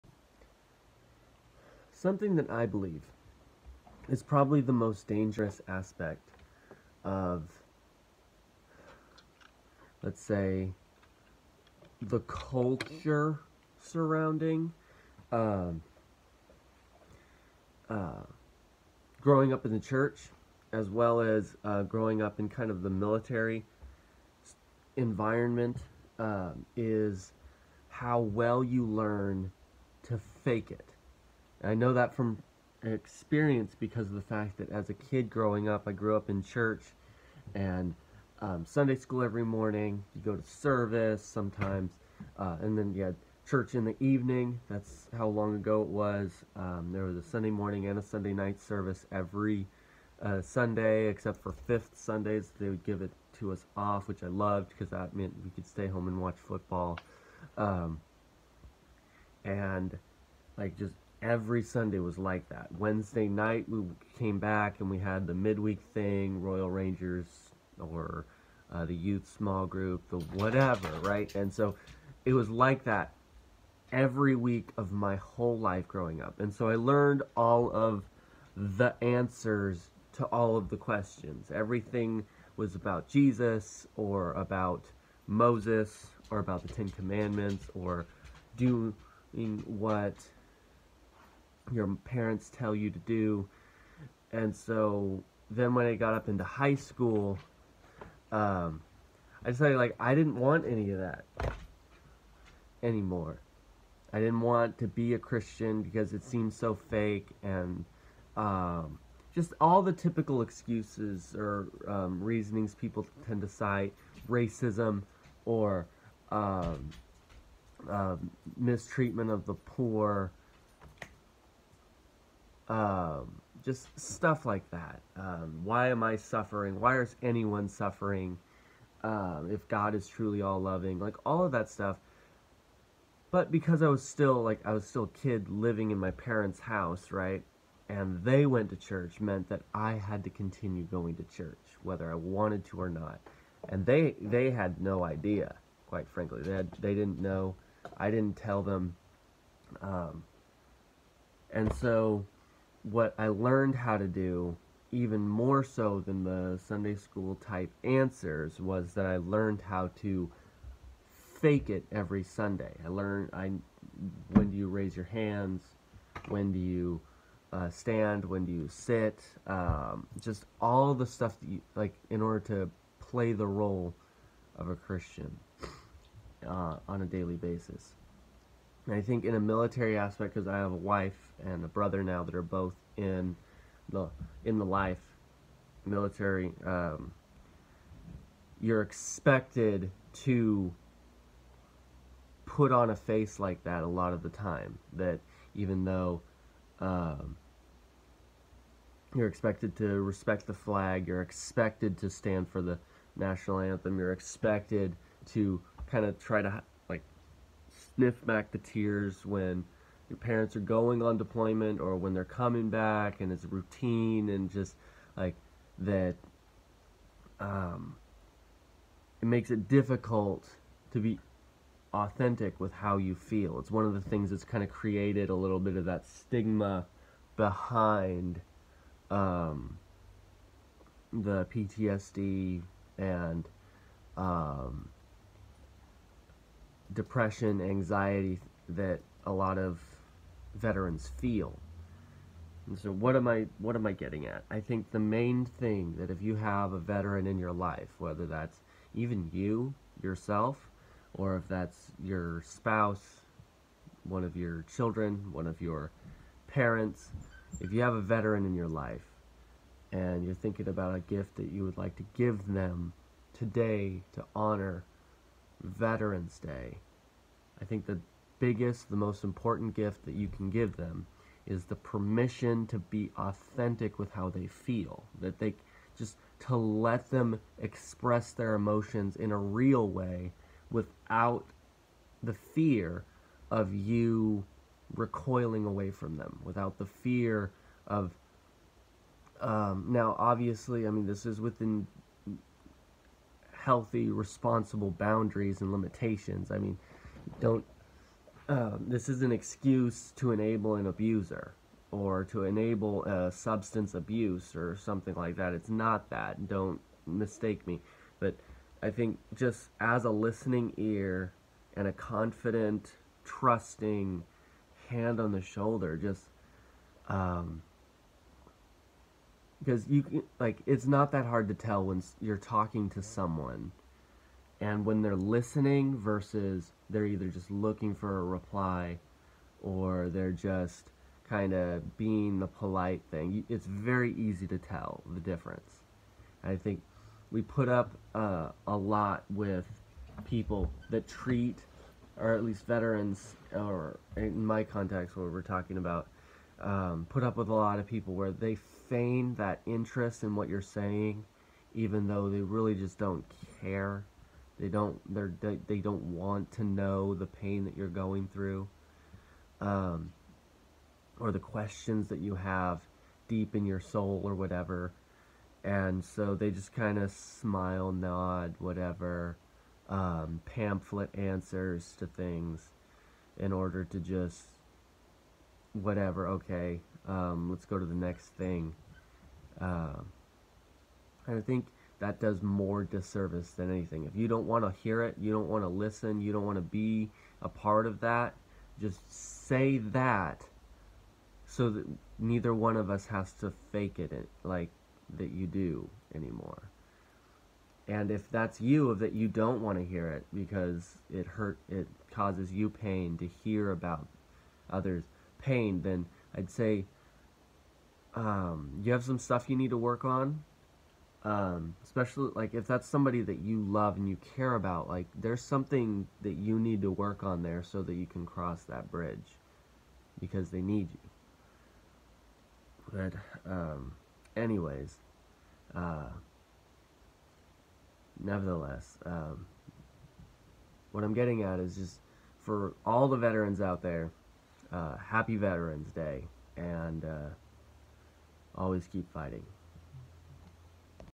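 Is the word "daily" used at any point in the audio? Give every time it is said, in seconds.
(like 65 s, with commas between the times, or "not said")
177 s.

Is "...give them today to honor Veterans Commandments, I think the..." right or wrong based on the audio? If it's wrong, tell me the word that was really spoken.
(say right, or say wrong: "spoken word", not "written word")
wrong: "Day", not "Commandments".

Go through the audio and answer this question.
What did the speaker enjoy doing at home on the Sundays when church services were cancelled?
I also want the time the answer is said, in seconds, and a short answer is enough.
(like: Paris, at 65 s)
Watch football, at 56 s.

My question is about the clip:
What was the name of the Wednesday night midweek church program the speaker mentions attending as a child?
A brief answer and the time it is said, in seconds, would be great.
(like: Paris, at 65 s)
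Royal Rangers, at 66 s.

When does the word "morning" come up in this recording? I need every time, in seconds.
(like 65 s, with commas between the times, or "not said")
39 s, 47 s.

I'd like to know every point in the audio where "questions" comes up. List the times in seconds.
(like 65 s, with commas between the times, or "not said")
80 s, 361 s.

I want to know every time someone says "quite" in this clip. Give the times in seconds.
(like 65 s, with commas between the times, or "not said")
145 s.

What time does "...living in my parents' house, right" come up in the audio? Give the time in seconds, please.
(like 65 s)
135 s.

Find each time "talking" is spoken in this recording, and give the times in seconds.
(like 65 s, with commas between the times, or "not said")
322 s, 345 s.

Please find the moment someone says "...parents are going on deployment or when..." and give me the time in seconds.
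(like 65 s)
210 s.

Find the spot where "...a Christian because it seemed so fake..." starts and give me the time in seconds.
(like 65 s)
105 s.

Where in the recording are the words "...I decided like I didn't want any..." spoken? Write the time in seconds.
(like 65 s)
99 s.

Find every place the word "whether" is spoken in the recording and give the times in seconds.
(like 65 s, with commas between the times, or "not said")
141 s, 247 s.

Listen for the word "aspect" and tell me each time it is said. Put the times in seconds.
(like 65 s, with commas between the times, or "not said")
5 s, 179 s.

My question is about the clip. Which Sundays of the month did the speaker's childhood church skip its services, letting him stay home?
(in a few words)
Fifth Sundays.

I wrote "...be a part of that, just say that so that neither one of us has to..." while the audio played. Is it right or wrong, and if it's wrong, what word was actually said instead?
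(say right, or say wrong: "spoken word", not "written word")
right.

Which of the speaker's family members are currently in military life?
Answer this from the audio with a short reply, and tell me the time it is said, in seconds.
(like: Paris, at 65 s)
A wife and a brother, at 180 s.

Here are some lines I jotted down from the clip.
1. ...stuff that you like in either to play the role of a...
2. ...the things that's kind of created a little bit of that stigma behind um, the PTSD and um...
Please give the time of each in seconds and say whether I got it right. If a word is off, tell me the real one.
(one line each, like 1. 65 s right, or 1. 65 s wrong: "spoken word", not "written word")
1. 171 s wrong: "order", not "either"
2. 223 s right.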